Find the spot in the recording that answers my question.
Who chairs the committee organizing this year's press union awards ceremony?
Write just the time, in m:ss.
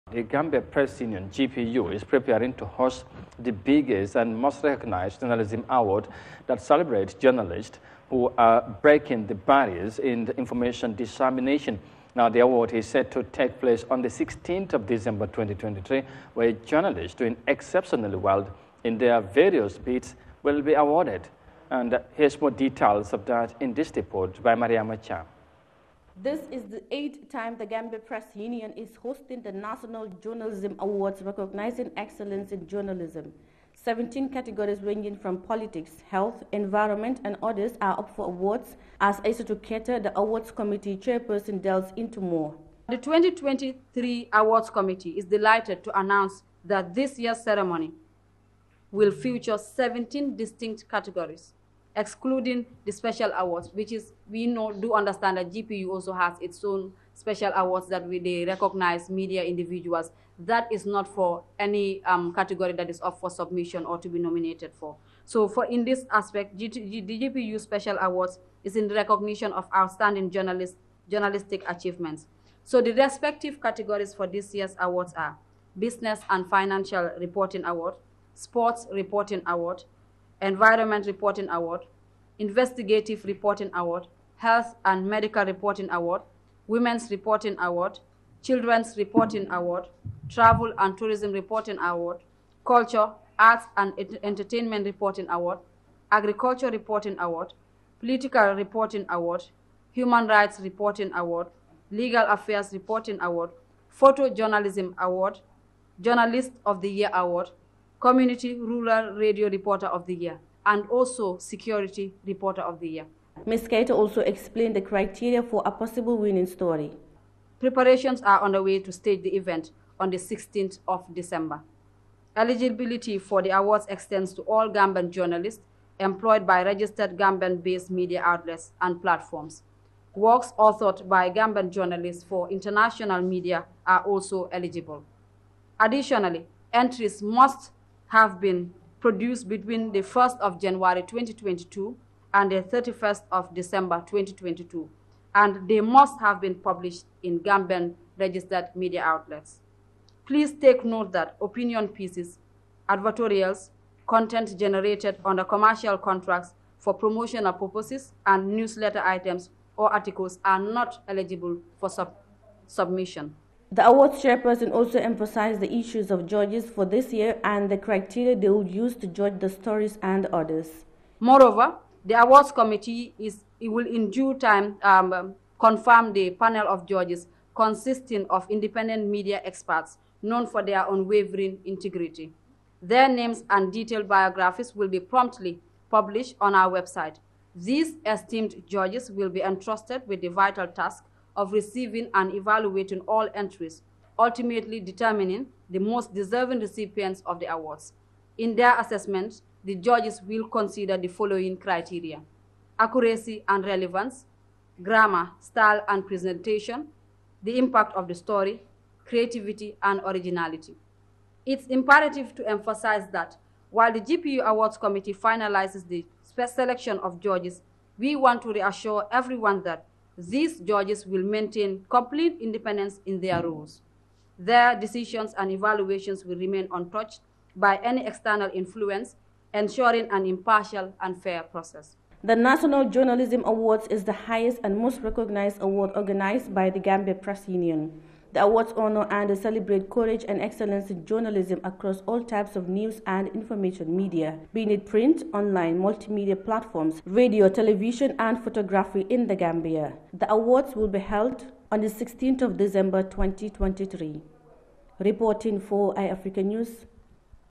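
0:38.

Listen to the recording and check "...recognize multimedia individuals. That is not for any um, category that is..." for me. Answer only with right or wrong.
wrong.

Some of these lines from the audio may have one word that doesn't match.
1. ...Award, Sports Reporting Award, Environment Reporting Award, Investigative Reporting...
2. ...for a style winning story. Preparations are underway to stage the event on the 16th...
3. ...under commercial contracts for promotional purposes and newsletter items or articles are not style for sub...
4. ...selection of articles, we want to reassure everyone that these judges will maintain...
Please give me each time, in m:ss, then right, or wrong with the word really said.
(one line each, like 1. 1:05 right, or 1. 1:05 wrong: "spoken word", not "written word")
1. 1:17 right
2. 1:55 wrong: "possible", not "style"
3. 2:35 wrong: "eligible", not "style"
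4. 3:36 wrong: "judges", not "articles".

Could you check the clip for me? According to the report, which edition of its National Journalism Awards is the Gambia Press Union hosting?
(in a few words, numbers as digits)
8th.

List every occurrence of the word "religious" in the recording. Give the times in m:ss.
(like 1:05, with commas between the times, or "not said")
not said.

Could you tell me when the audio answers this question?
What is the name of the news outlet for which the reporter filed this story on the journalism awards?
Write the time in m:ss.
4:15.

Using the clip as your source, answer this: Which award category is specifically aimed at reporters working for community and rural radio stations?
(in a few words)
Community Rural Radio Reporter of the Year.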